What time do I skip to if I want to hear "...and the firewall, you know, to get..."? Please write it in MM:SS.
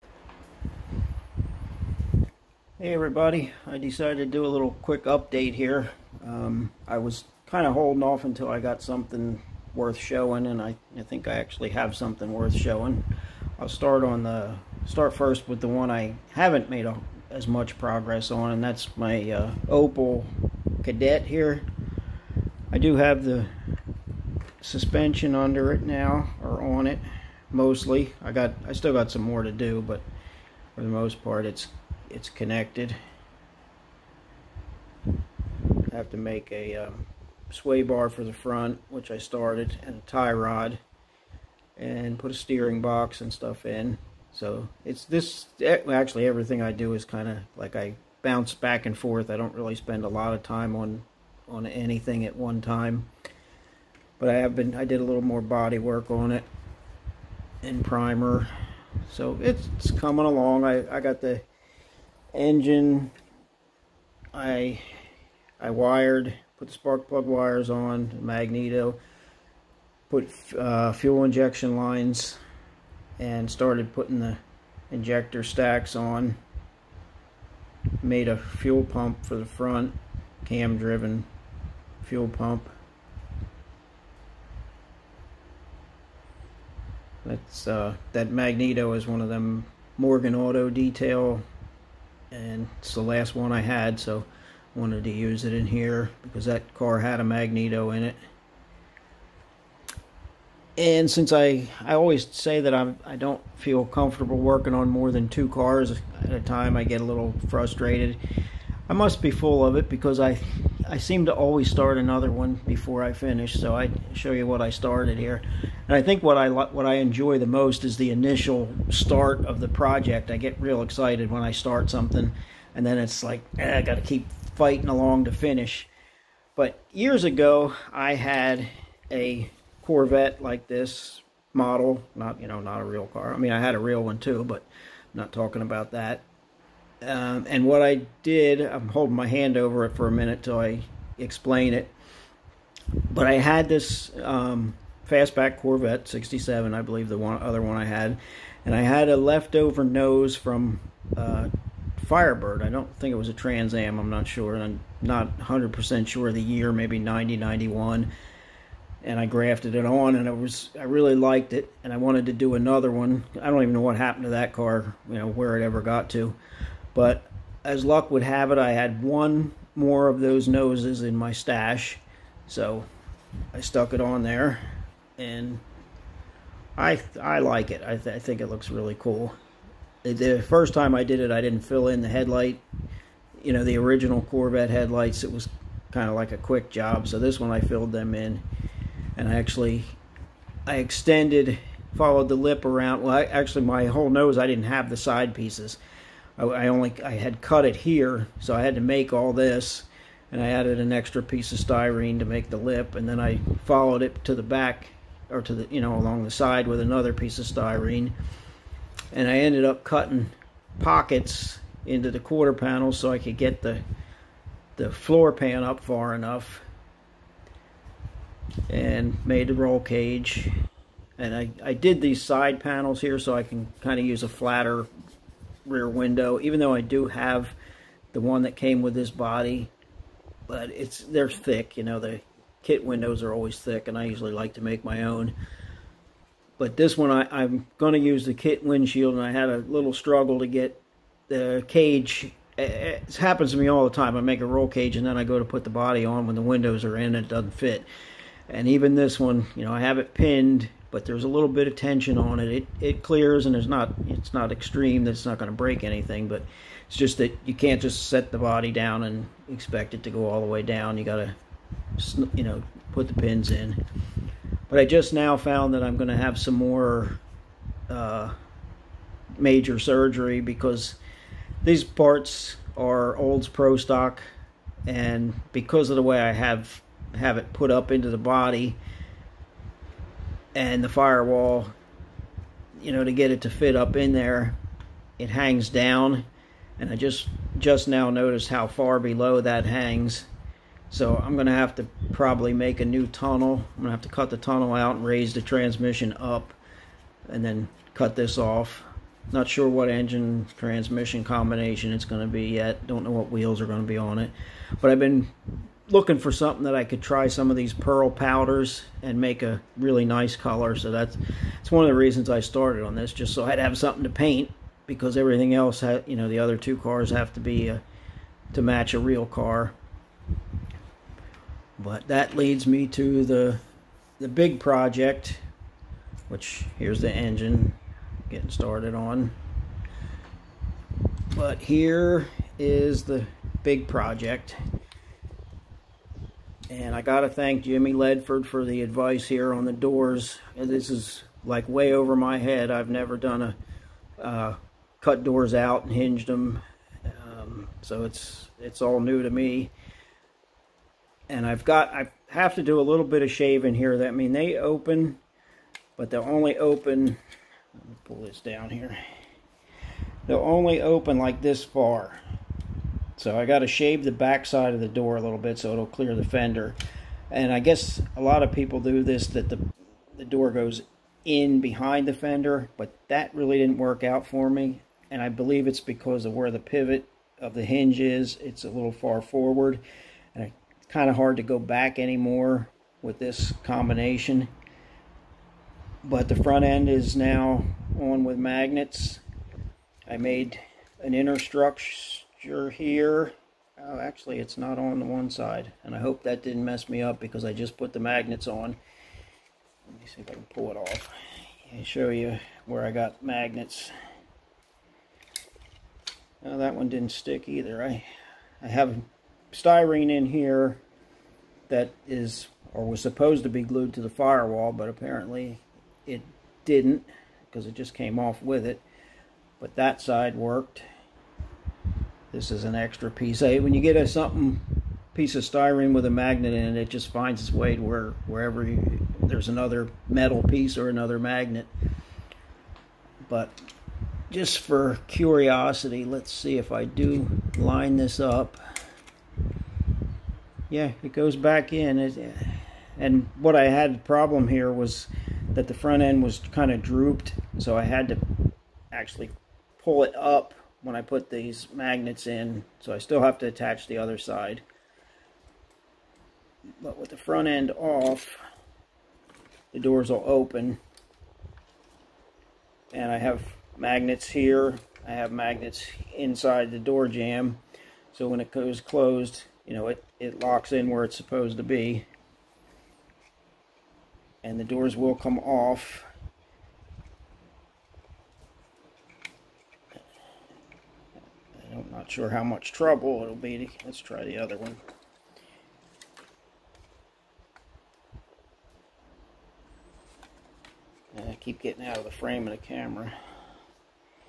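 04:40.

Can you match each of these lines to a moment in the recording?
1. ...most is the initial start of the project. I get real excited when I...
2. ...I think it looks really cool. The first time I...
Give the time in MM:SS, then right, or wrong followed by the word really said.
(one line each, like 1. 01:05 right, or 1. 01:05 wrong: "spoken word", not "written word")
1. 01:57 right
2. 02:58 right.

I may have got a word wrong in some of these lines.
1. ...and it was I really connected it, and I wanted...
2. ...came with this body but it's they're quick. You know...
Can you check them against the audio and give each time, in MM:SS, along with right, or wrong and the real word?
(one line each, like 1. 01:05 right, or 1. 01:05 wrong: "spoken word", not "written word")
1. 02:40 wrong: "liked", not "connected"
2. 03:48 wrong: "thick", not "quick".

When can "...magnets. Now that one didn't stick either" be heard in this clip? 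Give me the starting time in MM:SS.
06:43.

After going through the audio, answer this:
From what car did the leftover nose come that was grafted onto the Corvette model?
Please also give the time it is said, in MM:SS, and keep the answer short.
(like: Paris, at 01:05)
Firebird, at 02:32.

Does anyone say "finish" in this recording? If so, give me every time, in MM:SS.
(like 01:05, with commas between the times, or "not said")
01:53, 02:05.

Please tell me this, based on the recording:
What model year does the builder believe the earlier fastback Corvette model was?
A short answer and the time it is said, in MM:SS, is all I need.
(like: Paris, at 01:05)
67, at 02:26.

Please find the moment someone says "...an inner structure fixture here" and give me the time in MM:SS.
06:31.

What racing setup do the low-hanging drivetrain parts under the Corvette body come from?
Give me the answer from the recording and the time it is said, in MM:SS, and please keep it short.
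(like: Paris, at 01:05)
Olds Pro stock, at 04:33.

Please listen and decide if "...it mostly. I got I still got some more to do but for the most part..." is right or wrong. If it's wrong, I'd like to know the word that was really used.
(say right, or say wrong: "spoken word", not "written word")
right.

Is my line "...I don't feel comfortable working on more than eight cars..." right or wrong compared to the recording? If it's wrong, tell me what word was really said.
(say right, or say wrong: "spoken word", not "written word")
wrong: "two", not "eight".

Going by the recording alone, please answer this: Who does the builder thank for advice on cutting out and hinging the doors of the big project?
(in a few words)
Jimmy Ledford.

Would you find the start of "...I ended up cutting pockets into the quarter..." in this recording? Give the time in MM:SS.
03:29.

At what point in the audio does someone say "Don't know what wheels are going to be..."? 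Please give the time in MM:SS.
05:02.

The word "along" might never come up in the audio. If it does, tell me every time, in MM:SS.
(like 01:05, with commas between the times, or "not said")
01:00, 02:04, 03:25.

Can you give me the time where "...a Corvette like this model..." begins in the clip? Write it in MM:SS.
02:09.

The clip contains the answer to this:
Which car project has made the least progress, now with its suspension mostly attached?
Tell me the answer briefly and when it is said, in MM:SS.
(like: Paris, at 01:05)
Opel Kadett, at 00:19.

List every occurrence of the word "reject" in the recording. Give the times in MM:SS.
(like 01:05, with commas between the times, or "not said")
not said.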